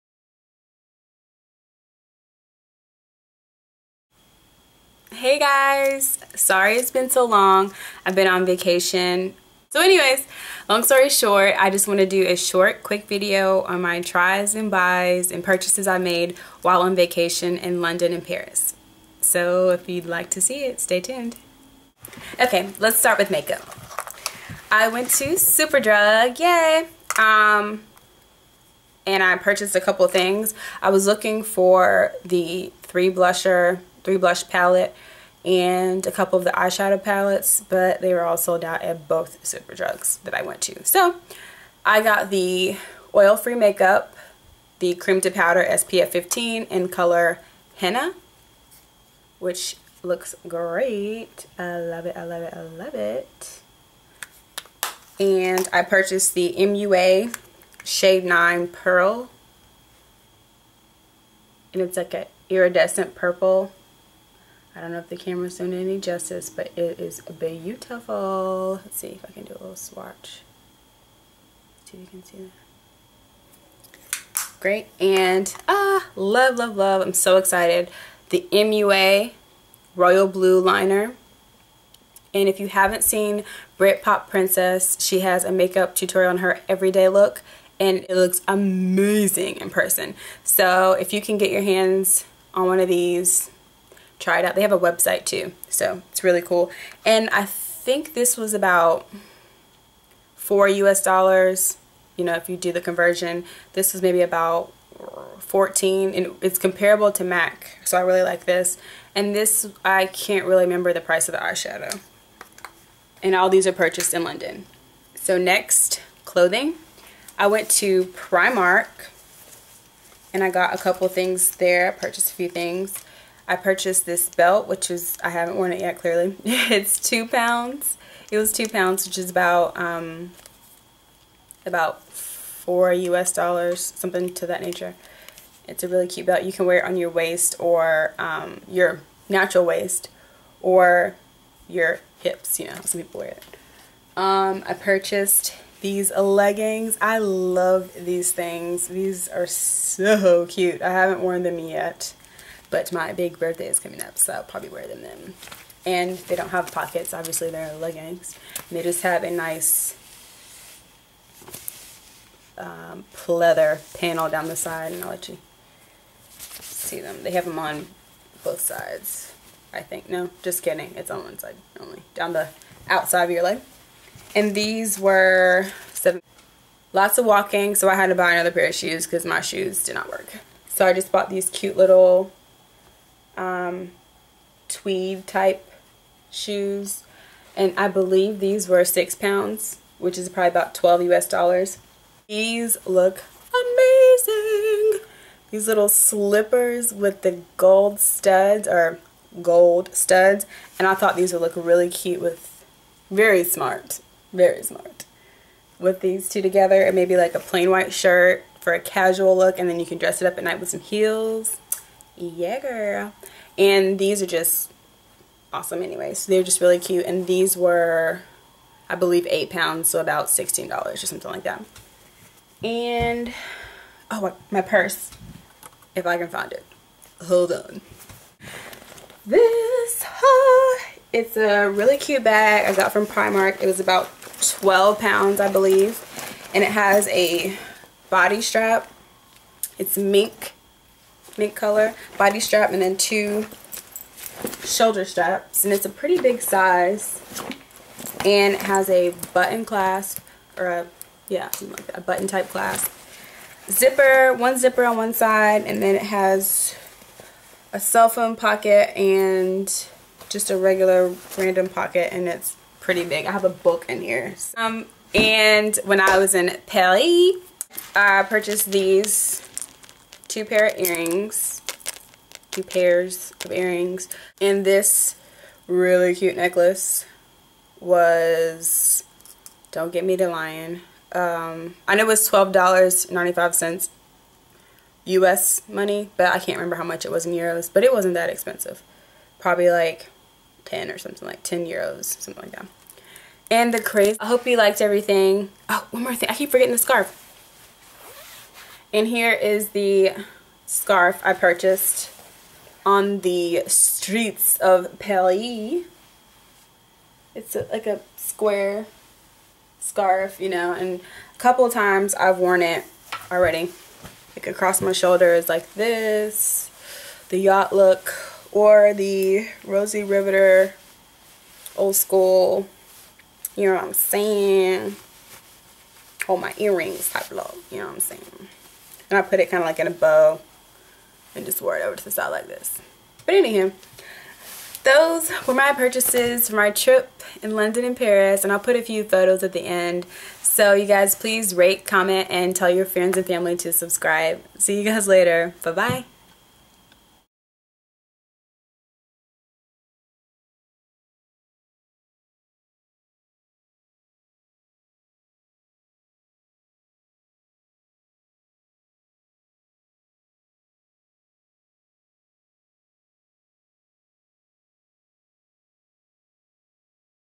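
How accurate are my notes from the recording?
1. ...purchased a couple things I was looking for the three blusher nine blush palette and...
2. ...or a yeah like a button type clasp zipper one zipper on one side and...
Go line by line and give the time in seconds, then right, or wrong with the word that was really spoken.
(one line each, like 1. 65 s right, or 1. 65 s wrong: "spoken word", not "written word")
1. 29 s wrong: "three", not "nine"
2. 250 s right.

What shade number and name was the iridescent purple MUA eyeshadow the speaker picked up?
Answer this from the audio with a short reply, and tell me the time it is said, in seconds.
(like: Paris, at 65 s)
Shade 9 Pearl, at 57 s.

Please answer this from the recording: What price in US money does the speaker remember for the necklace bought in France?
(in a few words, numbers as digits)
$12.95.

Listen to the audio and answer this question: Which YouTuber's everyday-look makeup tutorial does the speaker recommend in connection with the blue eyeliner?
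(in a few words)
Britpop Princess.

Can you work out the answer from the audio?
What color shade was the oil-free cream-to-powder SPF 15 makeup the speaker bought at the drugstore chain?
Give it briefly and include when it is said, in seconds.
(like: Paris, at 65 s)
Henna, at 47 s.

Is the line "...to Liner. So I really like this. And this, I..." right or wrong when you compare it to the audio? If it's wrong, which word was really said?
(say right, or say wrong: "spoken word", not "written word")
wrong: "MAC", not "Liner".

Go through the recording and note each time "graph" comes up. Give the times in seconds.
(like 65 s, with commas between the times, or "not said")
not said.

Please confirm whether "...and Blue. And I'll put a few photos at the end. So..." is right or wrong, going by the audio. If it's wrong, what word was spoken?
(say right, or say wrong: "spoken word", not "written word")
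wrong: "Paris", not "Blue".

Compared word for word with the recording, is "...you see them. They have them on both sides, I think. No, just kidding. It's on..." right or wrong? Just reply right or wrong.
right.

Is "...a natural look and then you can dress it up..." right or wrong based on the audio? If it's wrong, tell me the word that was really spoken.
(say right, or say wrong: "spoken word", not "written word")
wrong: "casual", not "natural".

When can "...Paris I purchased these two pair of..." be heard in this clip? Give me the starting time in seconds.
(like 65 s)
266 s.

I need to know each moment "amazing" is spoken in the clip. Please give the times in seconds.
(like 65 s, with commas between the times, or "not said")
88 s, 193 s.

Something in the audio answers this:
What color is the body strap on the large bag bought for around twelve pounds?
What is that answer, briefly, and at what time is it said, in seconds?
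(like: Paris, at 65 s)
Mint, at 241 s.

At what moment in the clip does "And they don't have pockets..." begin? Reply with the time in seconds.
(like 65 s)
155 s.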